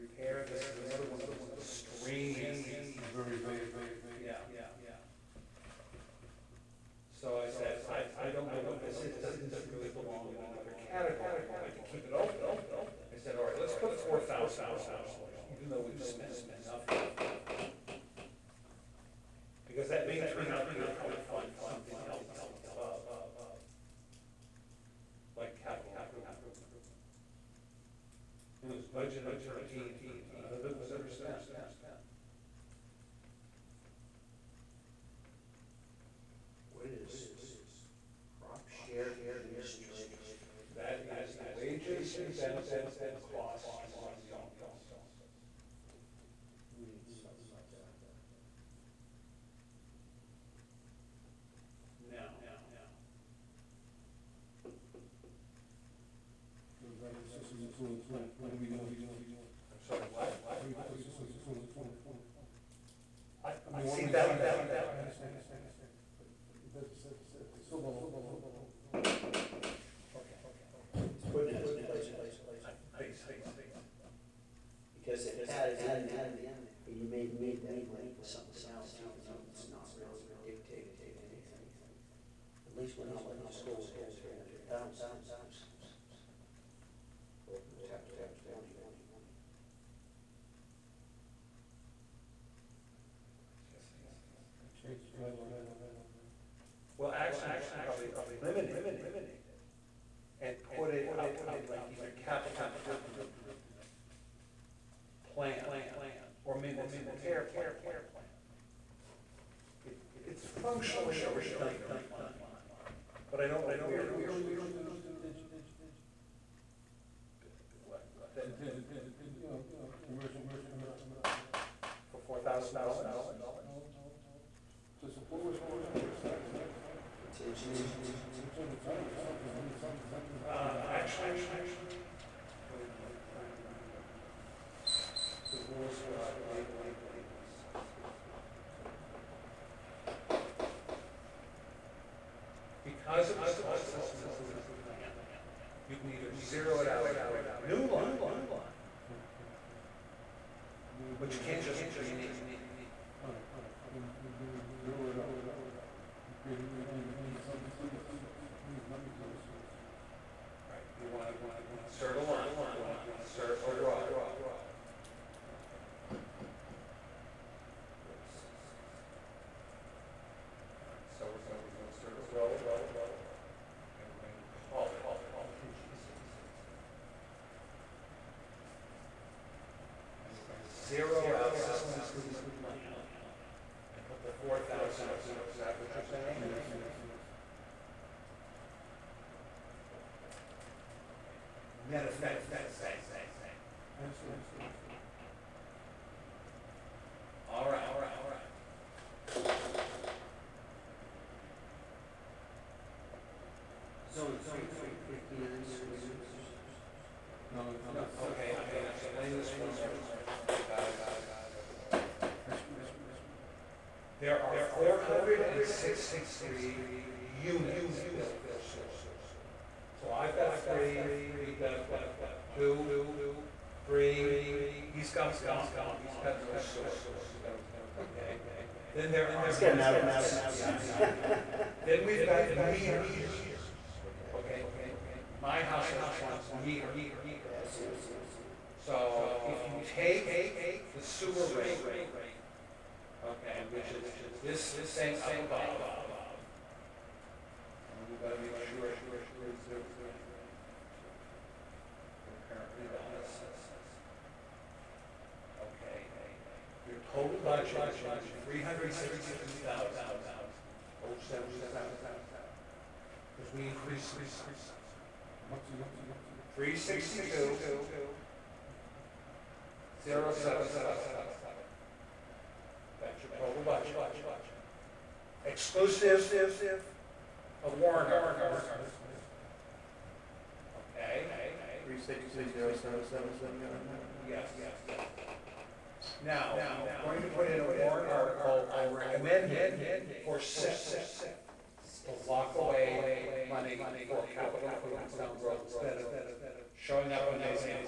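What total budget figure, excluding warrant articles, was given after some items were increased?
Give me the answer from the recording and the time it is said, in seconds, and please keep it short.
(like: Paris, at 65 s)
$362,077, at 258 s.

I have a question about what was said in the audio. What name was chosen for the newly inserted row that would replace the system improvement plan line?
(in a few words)
Contingency.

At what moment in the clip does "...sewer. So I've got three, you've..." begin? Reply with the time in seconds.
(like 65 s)
218 s.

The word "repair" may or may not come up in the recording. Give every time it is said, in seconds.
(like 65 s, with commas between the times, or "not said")
0 s, 107 s.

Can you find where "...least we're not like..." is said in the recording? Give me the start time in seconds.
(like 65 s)
82 s.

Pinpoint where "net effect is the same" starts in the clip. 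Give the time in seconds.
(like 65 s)
191 s.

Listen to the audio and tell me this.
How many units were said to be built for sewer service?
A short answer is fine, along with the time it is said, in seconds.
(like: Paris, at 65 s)
463, at 214 s.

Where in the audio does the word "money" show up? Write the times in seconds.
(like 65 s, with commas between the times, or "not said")
77 s, 293 s.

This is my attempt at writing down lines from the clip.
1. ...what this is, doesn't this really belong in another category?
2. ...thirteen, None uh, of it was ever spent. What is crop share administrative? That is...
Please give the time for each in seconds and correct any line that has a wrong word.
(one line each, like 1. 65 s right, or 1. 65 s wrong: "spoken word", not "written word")
1. 8 s right
2. 29 s right.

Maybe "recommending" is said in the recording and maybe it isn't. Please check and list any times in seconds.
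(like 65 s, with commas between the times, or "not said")
288 s.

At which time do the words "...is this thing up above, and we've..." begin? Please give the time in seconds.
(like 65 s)
243 s.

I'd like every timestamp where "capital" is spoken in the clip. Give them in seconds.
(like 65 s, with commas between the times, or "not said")
102 s, 294 s.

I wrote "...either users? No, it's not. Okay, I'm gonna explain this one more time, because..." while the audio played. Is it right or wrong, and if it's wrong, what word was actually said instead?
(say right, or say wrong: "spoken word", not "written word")
wrong: "sewer", not "either".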